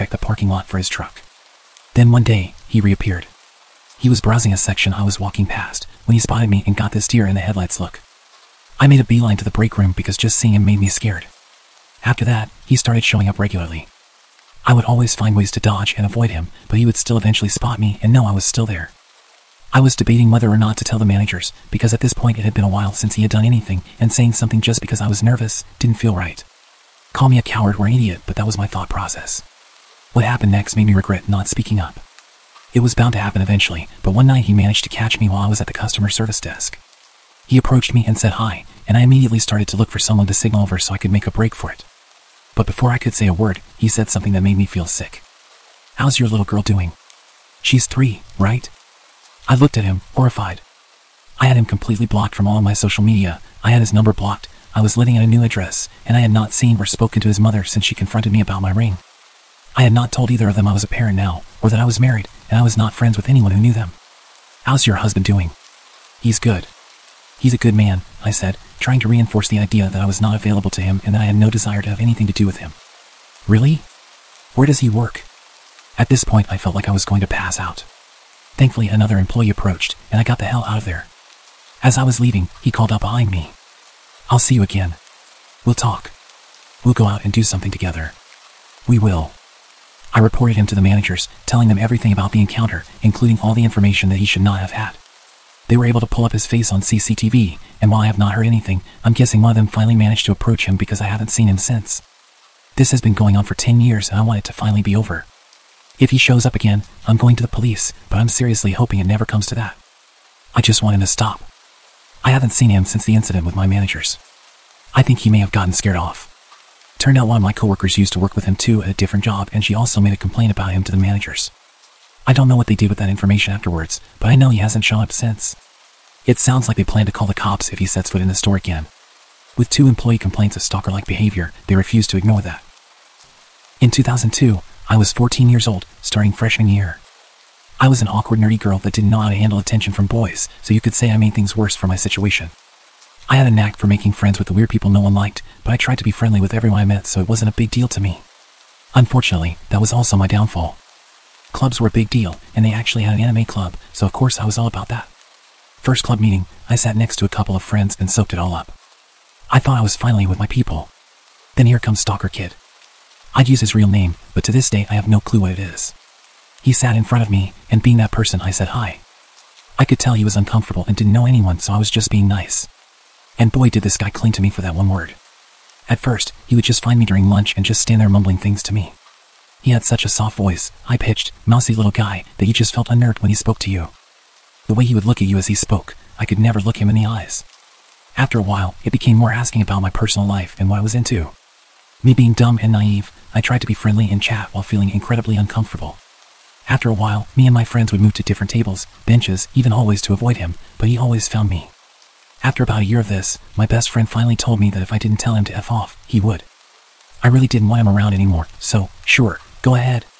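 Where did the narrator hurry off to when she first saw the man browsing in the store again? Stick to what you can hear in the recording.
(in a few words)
Break room.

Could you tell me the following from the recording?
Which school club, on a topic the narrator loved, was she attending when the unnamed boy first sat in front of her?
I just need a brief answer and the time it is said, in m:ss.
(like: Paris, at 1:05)
Anime club, at 2:33.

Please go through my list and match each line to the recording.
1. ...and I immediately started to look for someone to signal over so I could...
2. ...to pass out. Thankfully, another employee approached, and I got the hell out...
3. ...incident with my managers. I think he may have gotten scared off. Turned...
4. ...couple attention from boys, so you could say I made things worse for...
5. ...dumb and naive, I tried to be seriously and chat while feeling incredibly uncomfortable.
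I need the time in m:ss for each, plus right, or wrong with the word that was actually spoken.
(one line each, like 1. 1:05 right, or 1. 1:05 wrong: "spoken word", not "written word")
1. 0:38 right
2. 1:17 right
3. 1:53 right
4. 2:19 wrong: "handle", not "couple"
5. 3:12 wrong: "friendly", not "seriously".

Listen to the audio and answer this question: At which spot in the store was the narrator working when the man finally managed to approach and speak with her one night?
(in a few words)
Customer service desk.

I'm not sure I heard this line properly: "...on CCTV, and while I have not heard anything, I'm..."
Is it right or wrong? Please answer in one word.
right.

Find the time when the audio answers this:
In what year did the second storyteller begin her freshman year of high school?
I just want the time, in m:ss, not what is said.
2:13.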